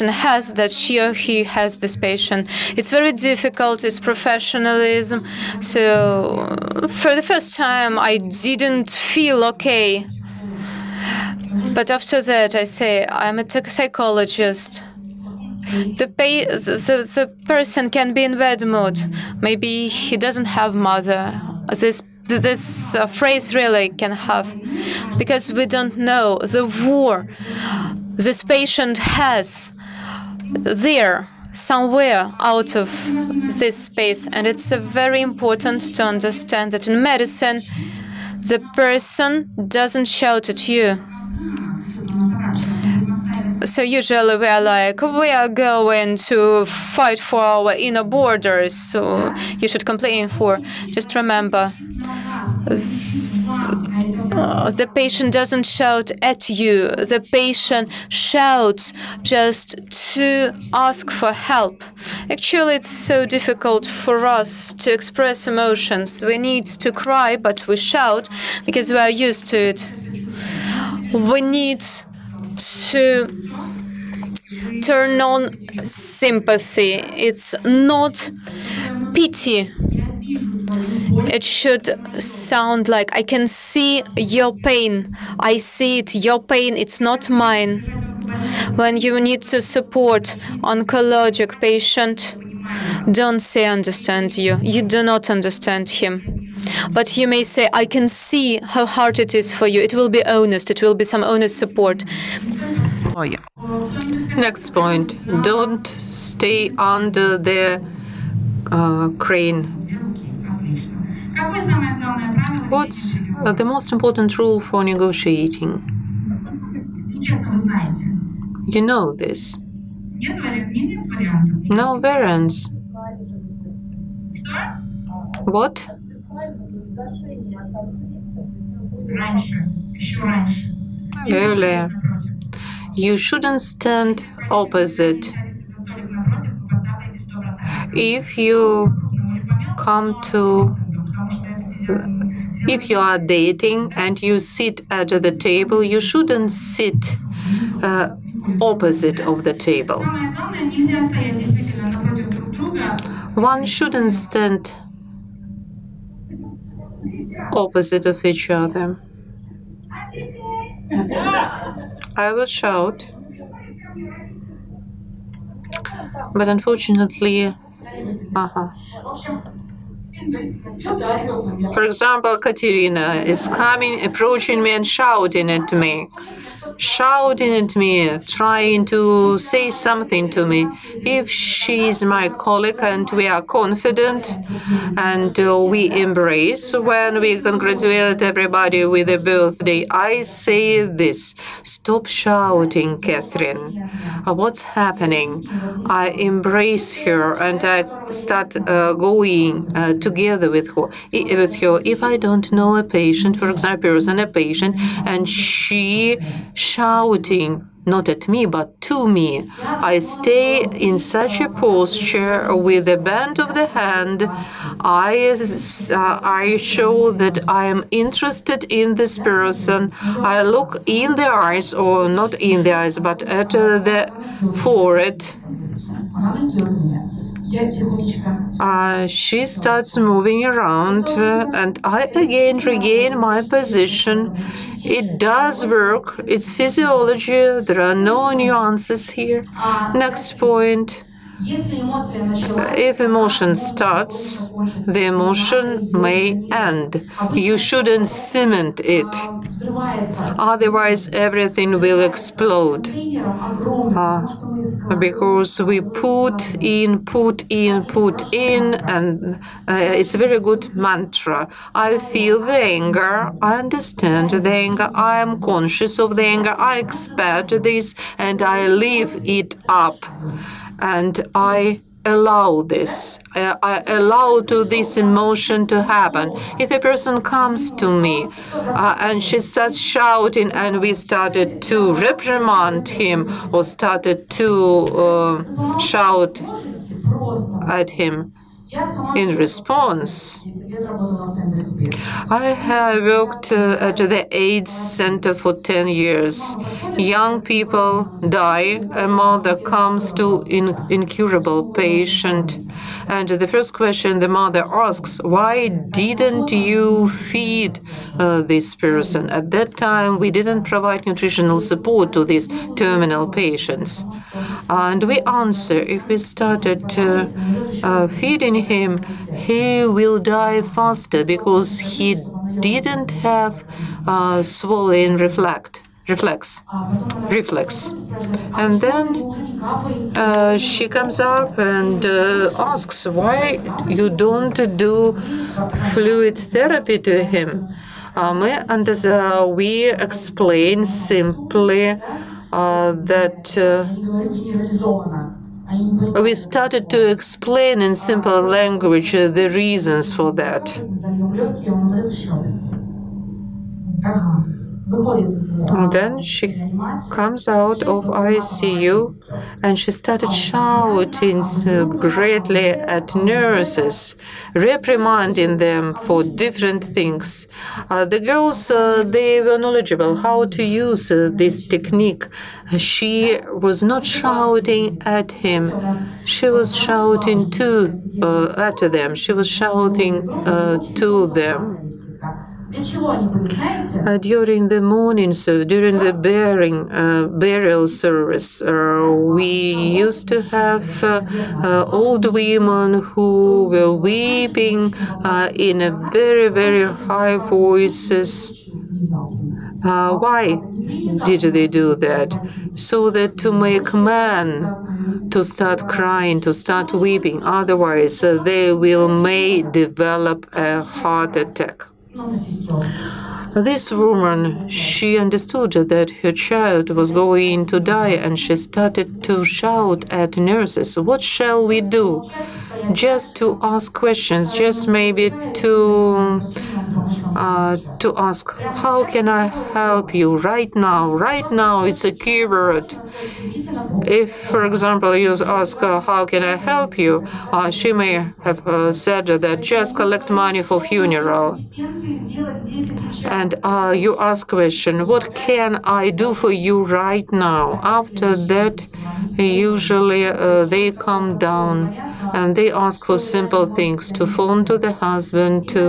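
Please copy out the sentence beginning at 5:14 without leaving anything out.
And we answer, if we started uh, feeding him, he will die faster because he didn't have uh, swallowing reflect, reflex, reflex.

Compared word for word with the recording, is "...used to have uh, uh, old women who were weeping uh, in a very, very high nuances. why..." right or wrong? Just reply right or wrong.
wrong.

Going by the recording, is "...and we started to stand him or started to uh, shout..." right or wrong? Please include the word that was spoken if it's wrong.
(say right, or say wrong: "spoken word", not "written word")
wrong: "reprimand", not "stand".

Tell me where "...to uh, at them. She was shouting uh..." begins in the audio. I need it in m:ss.
6:17.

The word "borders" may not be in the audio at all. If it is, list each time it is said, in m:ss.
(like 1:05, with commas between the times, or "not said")
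0:48.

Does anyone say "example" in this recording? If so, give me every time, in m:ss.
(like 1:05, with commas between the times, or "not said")
2:51, 3:23, 7:14.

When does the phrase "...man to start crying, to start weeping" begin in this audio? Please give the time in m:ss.
6:43.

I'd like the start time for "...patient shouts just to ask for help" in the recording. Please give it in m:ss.
0:57.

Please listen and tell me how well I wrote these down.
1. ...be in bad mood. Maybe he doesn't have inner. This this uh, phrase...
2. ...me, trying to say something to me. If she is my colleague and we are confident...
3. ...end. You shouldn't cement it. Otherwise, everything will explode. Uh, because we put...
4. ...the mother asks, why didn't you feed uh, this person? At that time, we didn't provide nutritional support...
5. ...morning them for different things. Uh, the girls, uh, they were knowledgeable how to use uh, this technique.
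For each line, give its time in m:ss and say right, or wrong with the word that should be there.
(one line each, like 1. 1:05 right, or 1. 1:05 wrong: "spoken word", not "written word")
1. 0:18 wrong: "mother", not "inner"
2. 2:57 right
3. 4:06 right
4. 5:04 right
5. 6:04 wrong: "reprimanding", not "morning".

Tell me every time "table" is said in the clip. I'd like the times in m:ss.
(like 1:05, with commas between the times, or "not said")
2:25, 2:29.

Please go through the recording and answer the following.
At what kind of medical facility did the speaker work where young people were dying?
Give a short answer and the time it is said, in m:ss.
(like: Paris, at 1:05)
AIDS Center, at 4:54.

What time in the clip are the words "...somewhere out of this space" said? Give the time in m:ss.
0:31.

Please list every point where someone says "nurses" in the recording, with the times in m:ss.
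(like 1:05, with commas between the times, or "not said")
6:03, 7:00.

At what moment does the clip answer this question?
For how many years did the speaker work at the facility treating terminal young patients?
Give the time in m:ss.
4:55.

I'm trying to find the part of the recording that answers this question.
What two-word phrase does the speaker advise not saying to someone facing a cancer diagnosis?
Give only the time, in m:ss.
1:33.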